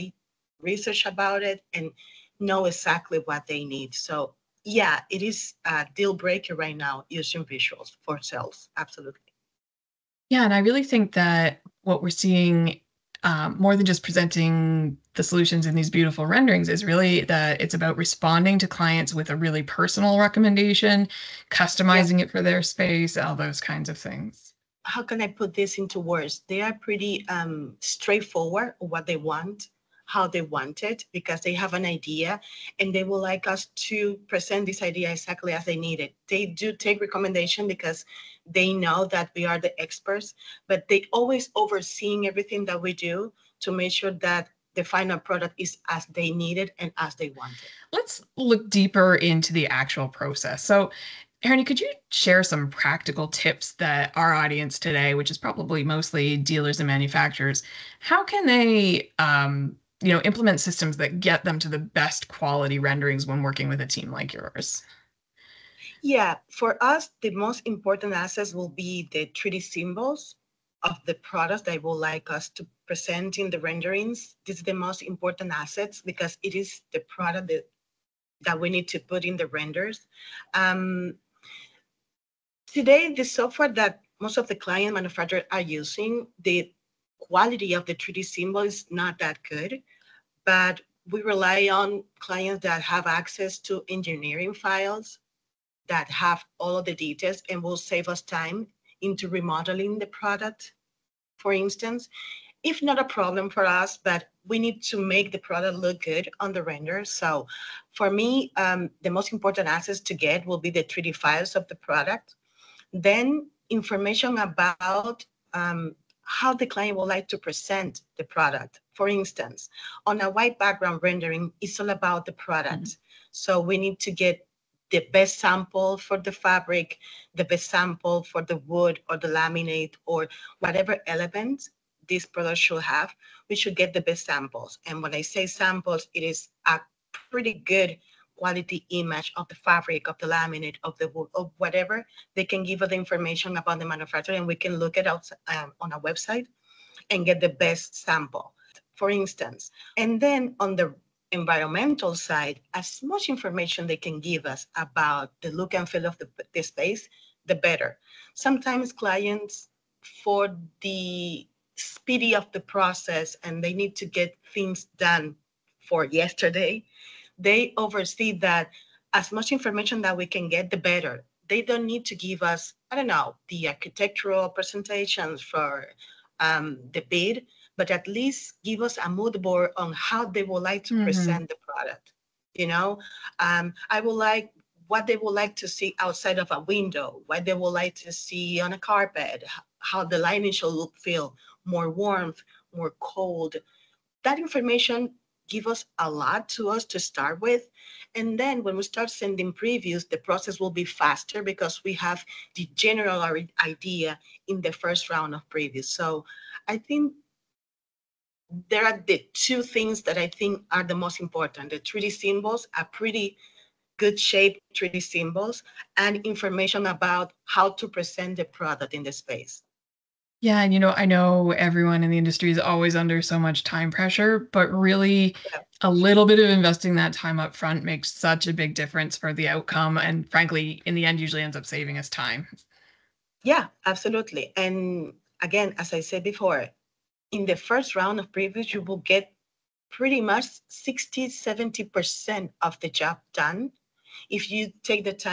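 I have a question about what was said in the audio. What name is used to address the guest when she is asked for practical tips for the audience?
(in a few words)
Harini.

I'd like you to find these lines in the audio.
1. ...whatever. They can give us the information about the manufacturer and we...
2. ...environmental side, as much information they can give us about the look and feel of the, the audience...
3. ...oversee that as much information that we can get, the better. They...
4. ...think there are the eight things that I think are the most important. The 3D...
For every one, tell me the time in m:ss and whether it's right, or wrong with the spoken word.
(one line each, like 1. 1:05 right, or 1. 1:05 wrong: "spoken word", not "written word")
1. 2:21 right
2. 2:31 wrong: "space", not "audience"
3. 2:47 right
4. 3:26 wrong: "two", not "eight".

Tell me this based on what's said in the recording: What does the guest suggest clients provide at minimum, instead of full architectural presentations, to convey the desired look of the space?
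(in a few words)
A mood board.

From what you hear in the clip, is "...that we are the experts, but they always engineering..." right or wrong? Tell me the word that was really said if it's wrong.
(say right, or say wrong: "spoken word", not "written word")
wrong: "overseeing", not "engineering".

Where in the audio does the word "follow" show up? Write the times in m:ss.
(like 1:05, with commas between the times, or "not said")
not said.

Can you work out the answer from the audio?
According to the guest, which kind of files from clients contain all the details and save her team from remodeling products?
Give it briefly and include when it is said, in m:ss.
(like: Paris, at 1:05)
Engineering files, at 1:33.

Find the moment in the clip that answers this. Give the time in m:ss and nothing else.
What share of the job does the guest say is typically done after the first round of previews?
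4:00.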